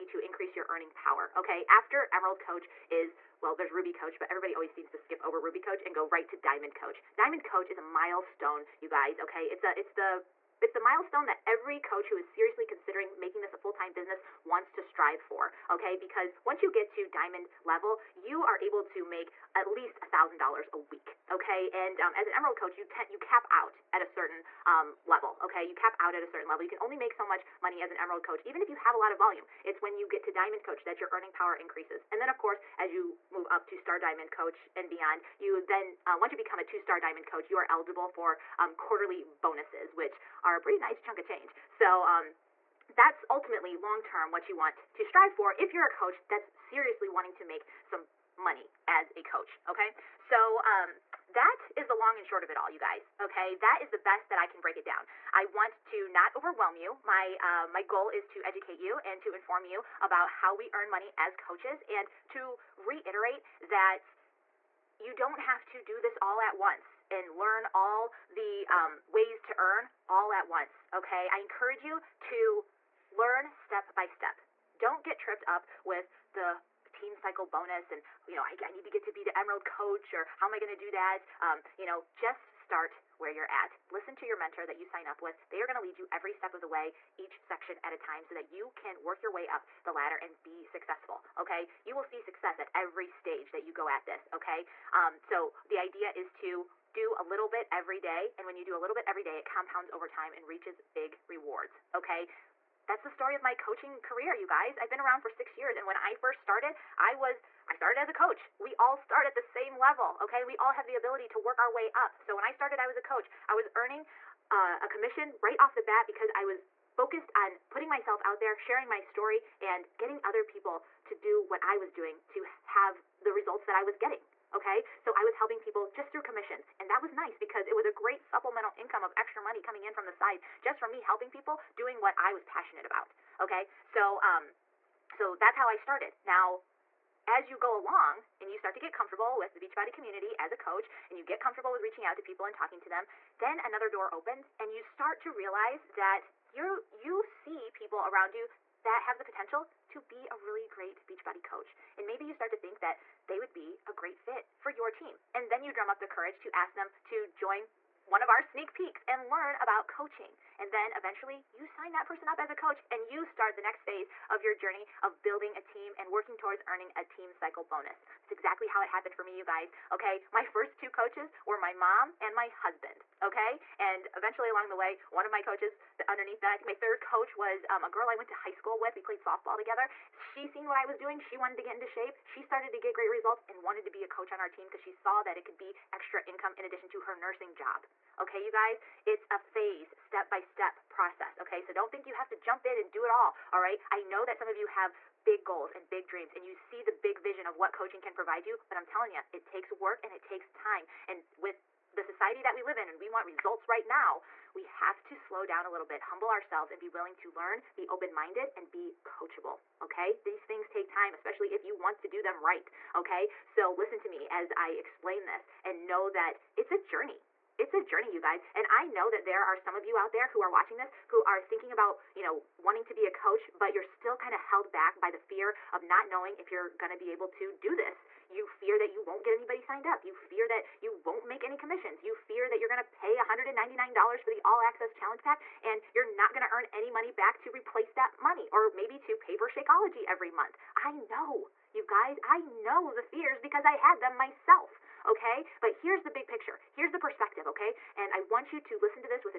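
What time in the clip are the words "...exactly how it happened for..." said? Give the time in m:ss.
2:48.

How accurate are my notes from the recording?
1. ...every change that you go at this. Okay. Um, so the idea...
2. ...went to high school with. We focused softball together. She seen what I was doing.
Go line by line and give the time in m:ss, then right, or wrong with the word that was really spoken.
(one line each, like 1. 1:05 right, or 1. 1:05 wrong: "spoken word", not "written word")
1. 1:32 wrong: "stage", not "change"
2. 2:58 wrong: "played", not "focused".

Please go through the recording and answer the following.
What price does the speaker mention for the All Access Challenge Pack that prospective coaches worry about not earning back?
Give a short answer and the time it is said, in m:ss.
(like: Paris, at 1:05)
$199, at 3:53.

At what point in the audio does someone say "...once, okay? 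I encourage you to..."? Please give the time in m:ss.
1:10.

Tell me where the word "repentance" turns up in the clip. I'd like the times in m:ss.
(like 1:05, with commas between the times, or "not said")
not said.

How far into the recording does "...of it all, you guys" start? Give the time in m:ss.
0:52.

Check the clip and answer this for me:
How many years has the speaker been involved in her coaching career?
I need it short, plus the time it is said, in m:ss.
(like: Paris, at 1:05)
6, at 1:45.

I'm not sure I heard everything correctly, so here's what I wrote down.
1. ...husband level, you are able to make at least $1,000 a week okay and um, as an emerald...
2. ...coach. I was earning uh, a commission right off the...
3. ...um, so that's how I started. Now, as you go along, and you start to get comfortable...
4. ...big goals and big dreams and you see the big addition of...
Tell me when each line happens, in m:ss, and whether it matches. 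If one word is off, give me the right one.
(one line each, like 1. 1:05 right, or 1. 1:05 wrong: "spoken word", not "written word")
1. 0:17 wrong: "diamond", not "husband"
2. 1:52 right
3. 2:14 right
4. 3:15 wrong: "vision", not "addition".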